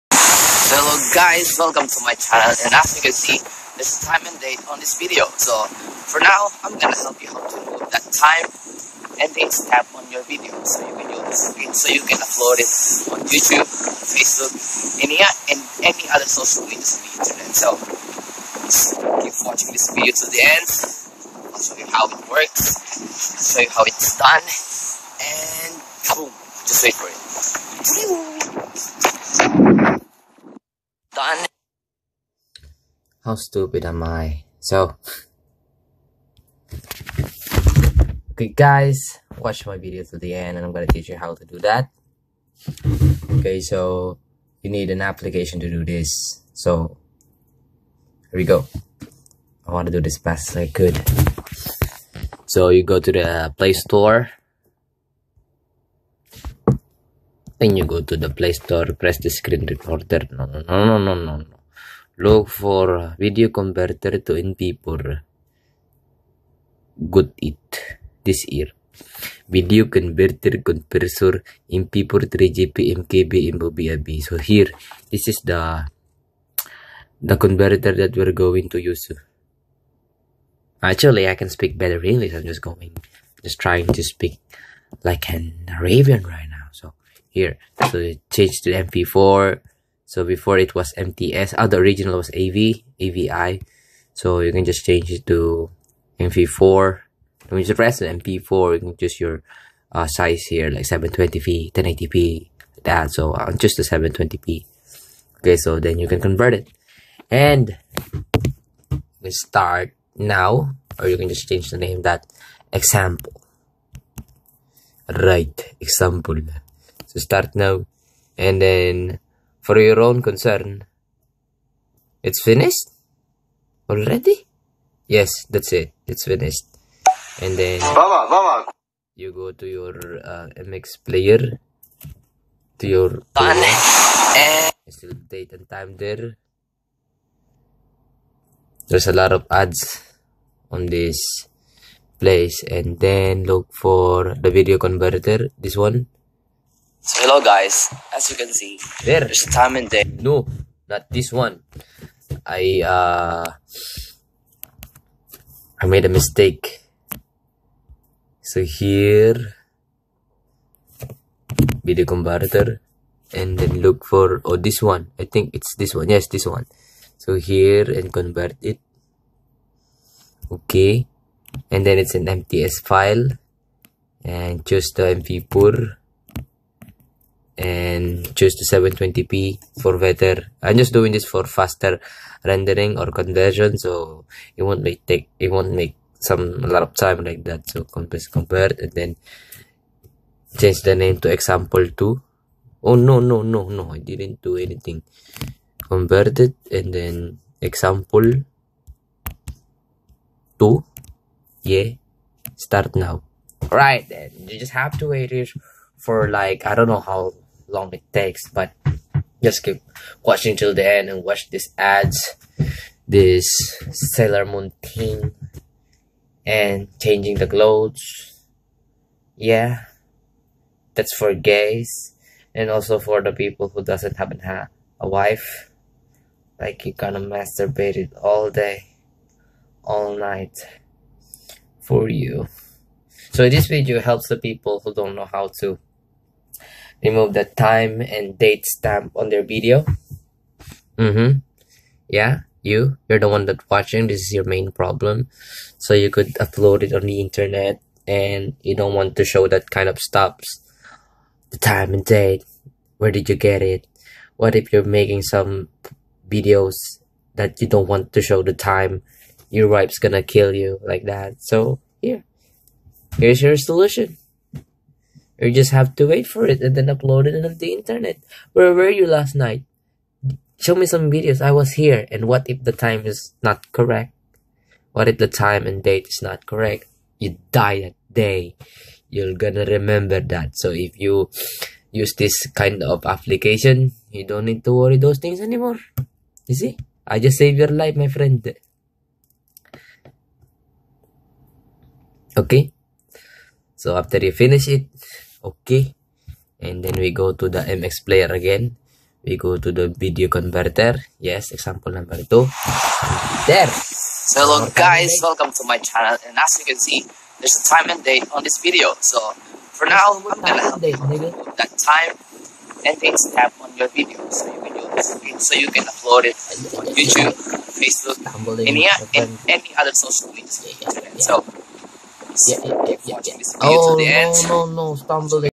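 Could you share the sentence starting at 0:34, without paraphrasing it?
So, okay, guys, watch my video to the end, and I'm gonna teach you how to do that.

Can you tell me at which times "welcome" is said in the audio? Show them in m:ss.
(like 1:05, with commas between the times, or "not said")
0:01, 5:05.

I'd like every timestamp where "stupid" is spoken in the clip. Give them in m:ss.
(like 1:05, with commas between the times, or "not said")
0:33.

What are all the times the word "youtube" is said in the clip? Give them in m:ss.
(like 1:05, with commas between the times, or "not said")
0:13, 5:16.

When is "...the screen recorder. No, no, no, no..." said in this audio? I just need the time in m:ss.
0:59.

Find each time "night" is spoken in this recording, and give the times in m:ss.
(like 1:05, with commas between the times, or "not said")
3:50, 4:29.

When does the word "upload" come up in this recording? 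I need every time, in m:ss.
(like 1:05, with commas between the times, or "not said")
0:12, 4:06, 4:26, 5:15.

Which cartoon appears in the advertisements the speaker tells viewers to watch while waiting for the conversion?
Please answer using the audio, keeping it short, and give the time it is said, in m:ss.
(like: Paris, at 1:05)
Sailor Moon, at 3:34.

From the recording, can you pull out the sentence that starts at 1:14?
So here, this is the the converter that we're going to use.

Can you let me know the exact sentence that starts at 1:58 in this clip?
And then, for your own concern, it's finished?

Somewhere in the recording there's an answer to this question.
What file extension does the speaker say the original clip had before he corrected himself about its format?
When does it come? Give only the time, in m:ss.
1:33.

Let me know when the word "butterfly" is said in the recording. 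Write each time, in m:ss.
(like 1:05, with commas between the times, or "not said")
not said.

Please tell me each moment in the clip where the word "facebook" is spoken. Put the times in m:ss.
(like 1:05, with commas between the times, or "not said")
0:13, 5:17.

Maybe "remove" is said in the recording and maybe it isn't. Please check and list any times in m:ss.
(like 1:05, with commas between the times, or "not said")
0:07, 3:57.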